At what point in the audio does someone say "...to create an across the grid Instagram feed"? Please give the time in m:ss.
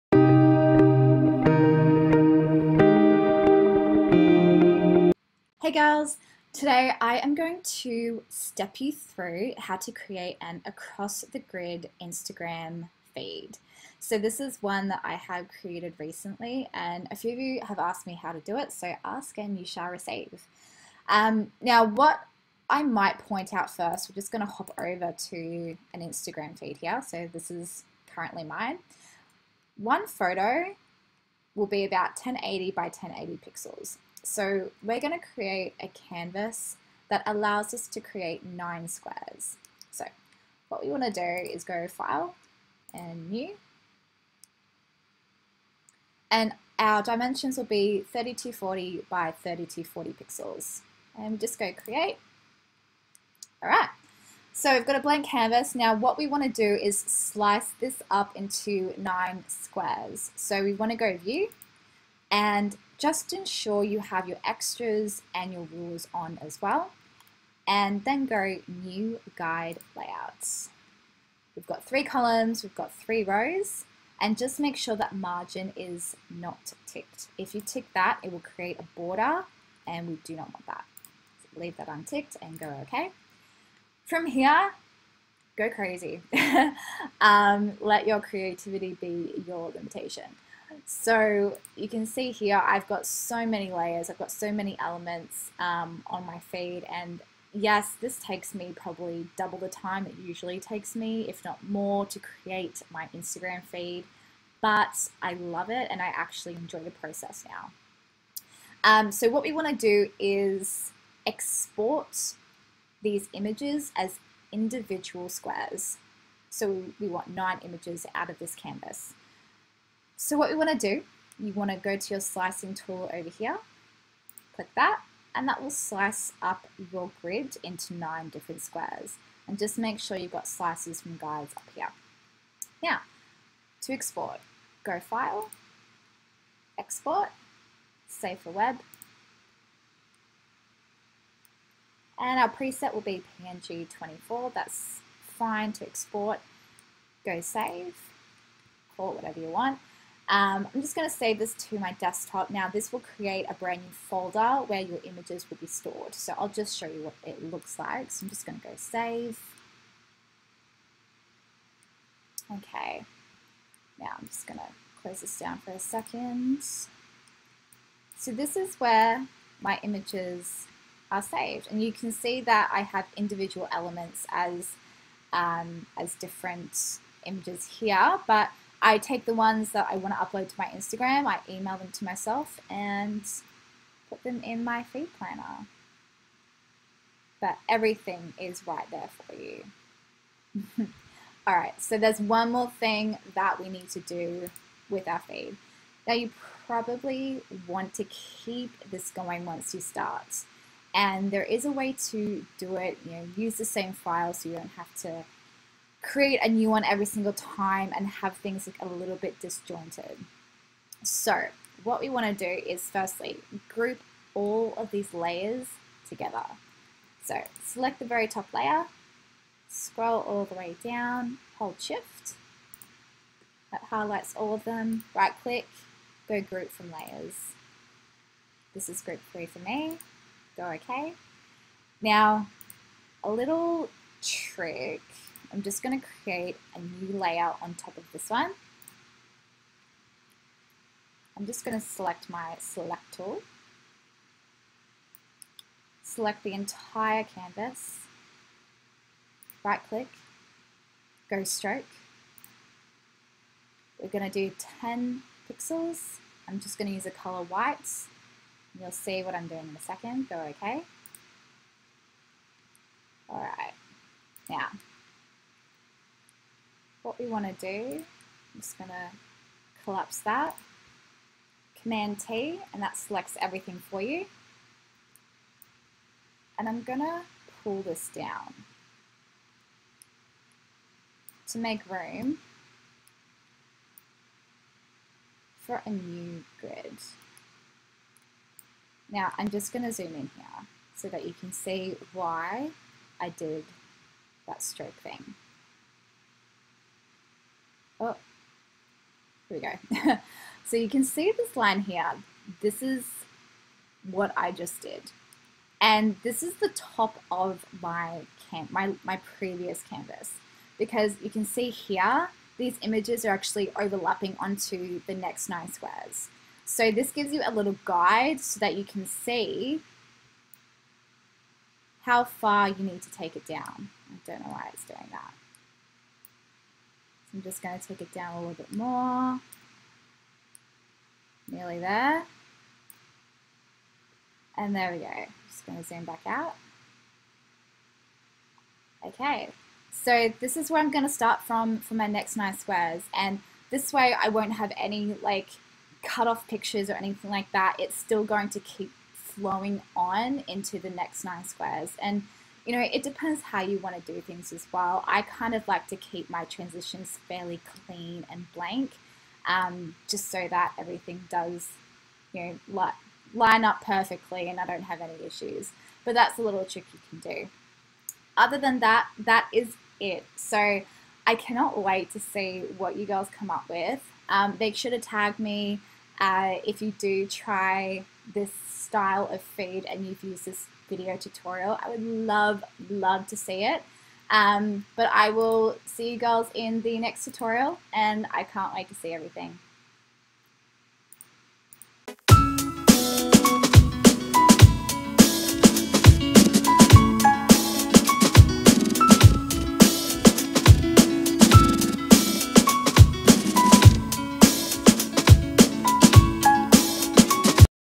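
0:09.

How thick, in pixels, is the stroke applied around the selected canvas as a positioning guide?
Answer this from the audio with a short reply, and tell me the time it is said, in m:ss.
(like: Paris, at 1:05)
10 pixels, at 4:14.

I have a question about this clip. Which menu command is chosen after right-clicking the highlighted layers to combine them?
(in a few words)
group from layers.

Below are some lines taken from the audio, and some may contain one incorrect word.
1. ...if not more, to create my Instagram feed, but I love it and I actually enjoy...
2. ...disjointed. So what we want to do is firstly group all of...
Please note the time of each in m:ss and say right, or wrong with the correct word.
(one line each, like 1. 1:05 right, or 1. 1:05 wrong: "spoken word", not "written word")
1. 1:41 right
2. 3:29 right.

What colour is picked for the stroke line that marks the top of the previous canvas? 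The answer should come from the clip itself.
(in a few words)
white.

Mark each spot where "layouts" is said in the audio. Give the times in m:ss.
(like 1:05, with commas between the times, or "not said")
1:09.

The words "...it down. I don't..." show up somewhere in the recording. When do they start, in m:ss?
5:23.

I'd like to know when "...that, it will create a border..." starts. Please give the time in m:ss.
1:17.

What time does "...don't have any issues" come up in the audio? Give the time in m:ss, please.
6:04.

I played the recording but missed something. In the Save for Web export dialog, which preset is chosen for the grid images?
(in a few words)
PNG 24.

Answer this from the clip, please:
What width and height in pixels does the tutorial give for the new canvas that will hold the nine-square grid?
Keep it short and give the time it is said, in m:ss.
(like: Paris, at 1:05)
3240 by 3240 pixels, at 0:48.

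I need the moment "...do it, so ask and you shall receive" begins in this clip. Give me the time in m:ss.
0:18.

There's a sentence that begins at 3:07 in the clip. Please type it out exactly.
But everything is right there for you.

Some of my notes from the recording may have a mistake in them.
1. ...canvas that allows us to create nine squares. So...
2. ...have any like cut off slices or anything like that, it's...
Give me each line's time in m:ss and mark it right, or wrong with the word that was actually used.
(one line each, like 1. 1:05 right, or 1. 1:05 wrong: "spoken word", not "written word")
1. 0:35 right
2. 5:44 wrong: "pictures", not "slices".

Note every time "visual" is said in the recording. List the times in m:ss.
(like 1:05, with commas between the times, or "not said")
not said.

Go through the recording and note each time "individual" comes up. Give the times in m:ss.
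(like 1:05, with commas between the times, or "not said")
1:54, 2:53.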